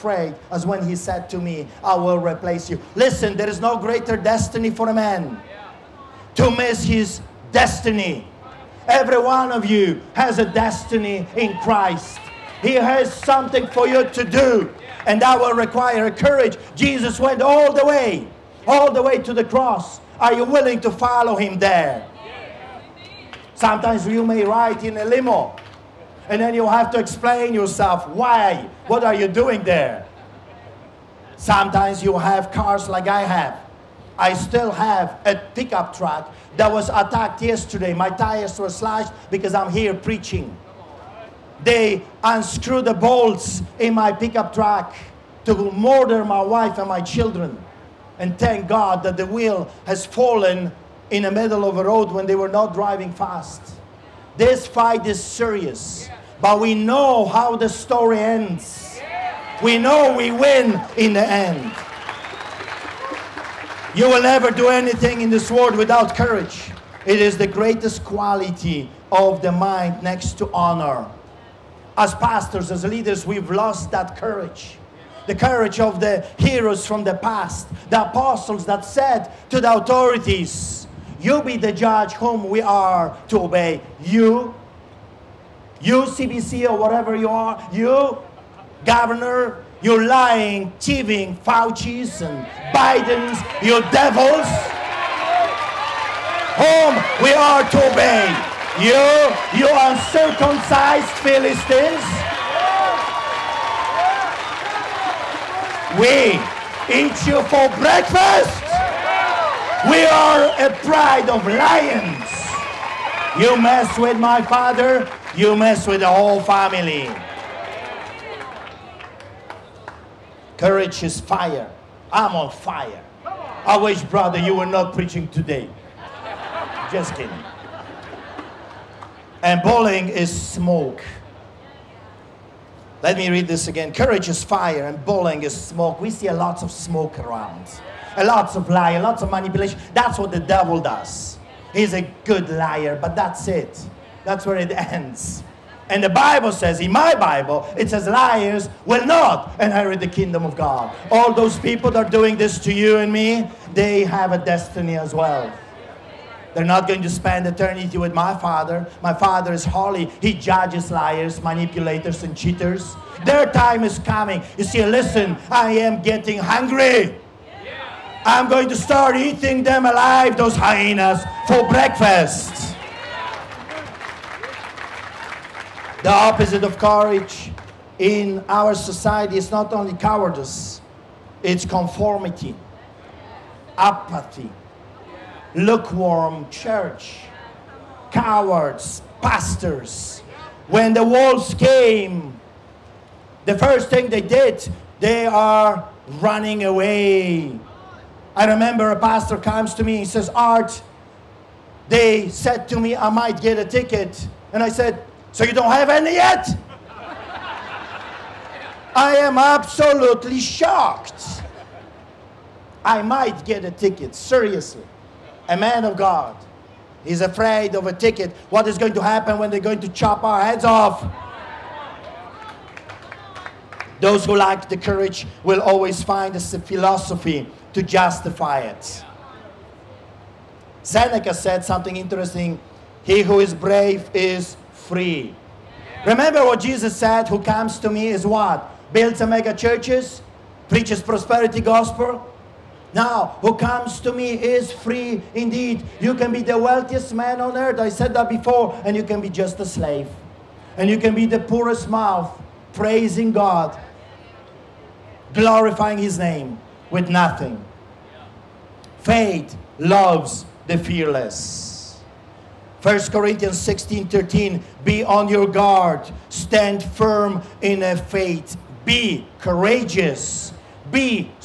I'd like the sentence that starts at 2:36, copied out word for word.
They're not going to spend eternity with my father.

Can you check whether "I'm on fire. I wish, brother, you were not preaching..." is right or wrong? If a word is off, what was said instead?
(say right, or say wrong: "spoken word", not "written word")
right.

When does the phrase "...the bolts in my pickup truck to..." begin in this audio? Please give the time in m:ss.
0:42.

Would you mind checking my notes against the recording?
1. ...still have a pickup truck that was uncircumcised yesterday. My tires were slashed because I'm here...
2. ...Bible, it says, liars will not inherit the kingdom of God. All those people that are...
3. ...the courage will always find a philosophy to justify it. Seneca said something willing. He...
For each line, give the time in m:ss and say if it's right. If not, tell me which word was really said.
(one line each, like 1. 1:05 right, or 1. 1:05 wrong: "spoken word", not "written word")
1. 0:34 wrong: "attacked", not "uncircumcised"
2. 2:27 right
3. 3:44 wrong: "interesting", not "willing".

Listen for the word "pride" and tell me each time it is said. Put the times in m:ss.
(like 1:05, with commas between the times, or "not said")
1:50.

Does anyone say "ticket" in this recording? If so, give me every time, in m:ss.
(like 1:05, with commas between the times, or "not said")
3:23, 3:33, 3:37.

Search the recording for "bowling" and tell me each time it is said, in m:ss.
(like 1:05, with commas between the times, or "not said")
2:09, 2:15.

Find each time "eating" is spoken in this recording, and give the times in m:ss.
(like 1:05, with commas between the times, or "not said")
2:49.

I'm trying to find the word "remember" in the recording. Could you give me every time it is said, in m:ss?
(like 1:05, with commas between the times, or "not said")
3:18, 3:56.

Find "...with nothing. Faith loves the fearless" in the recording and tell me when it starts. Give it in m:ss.
4:16.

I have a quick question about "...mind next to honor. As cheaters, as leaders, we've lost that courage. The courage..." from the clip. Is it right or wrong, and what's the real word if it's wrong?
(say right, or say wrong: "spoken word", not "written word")
wrong: "pastors", not "cheaters".